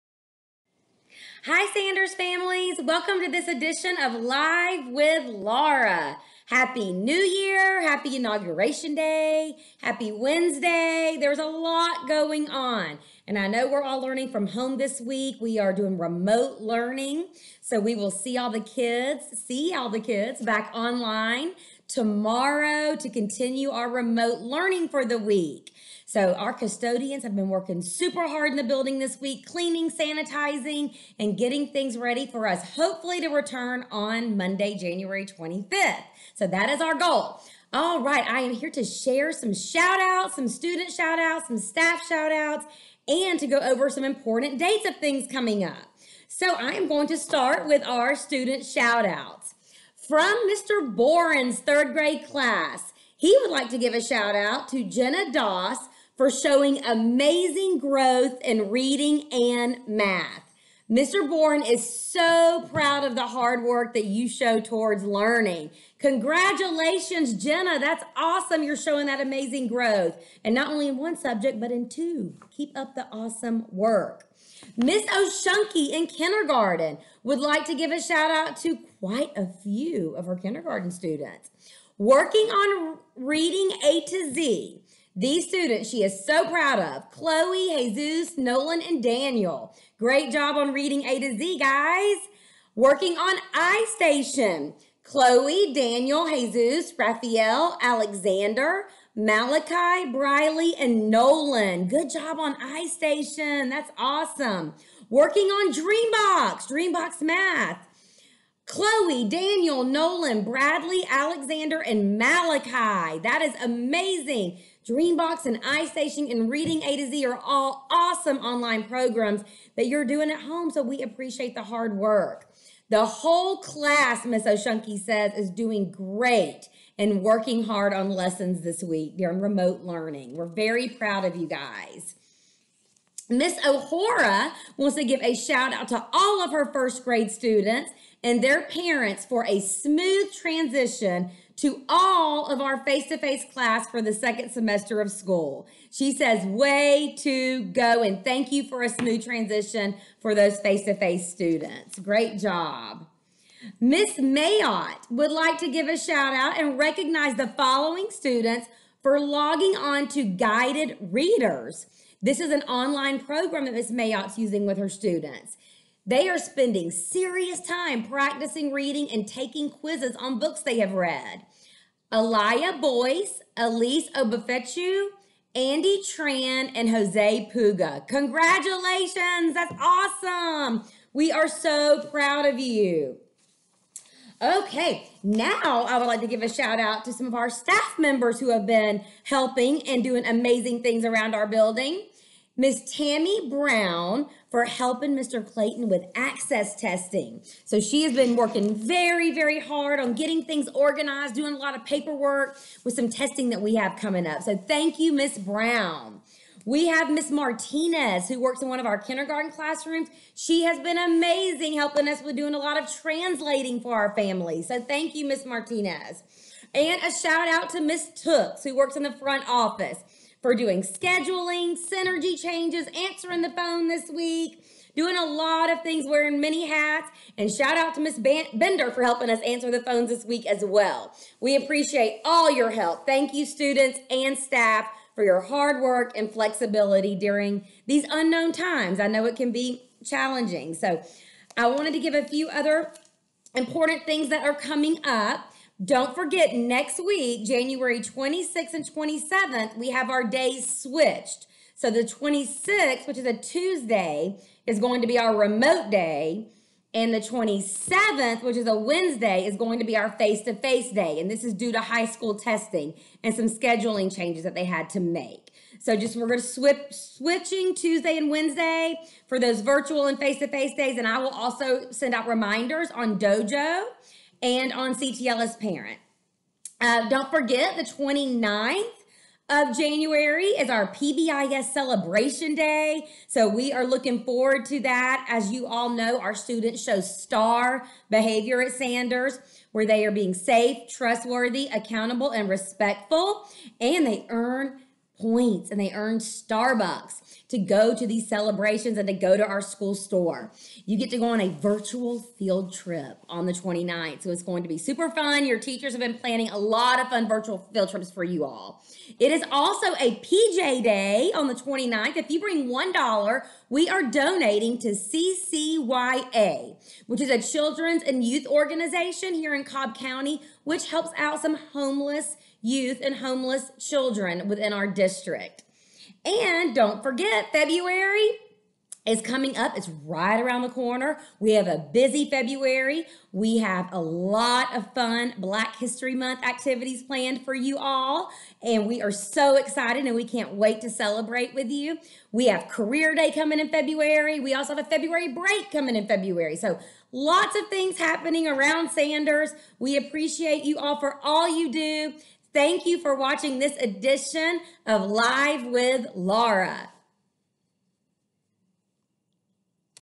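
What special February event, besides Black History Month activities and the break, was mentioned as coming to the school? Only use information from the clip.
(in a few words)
Career Day.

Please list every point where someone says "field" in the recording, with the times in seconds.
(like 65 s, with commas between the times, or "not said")
302 s, 307 s.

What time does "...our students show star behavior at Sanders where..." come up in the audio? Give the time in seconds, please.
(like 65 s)
286 s.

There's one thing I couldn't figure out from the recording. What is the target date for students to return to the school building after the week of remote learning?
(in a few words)
January 25th.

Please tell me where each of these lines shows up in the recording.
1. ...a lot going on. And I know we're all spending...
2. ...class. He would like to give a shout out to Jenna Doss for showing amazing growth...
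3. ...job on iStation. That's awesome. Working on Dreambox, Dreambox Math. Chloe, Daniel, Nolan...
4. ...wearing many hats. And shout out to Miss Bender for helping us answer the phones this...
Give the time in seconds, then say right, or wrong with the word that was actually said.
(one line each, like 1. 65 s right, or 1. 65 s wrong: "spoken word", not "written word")
1. 11 s wrong: "learning", not "spending"
2. 52 s right
3. 102 s right
4. 226 s right.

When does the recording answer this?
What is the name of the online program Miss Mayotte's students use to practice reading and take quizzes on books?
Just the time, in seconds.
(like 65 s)
160 s.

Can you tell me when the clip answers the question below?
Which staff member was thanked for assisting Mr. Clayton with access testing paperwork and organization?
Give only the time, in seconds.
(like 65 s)
192 s.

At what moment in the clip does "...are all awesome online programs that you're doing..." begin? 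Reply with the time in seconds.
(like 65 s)
117 s.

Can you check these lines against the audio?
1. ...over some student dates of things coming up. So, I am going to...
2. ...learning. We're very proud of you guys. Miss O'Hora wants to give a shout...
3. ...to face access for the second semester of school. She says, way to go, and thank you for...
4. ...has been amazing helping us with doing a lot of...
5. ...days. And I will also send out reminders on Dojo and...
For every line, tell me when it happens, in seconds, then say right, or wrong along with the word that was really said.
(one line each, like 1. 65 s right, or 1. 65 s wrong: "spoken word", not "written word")
1. 43 s wrong: "important", not "student"
2. 129 s right
3. 143 s wrong: "class", not "access"
4. 210 s right
5. 270 s right.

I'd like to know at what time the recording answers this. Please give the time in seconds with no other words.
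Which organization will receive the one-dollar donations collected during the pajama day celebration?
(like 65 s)
314 s.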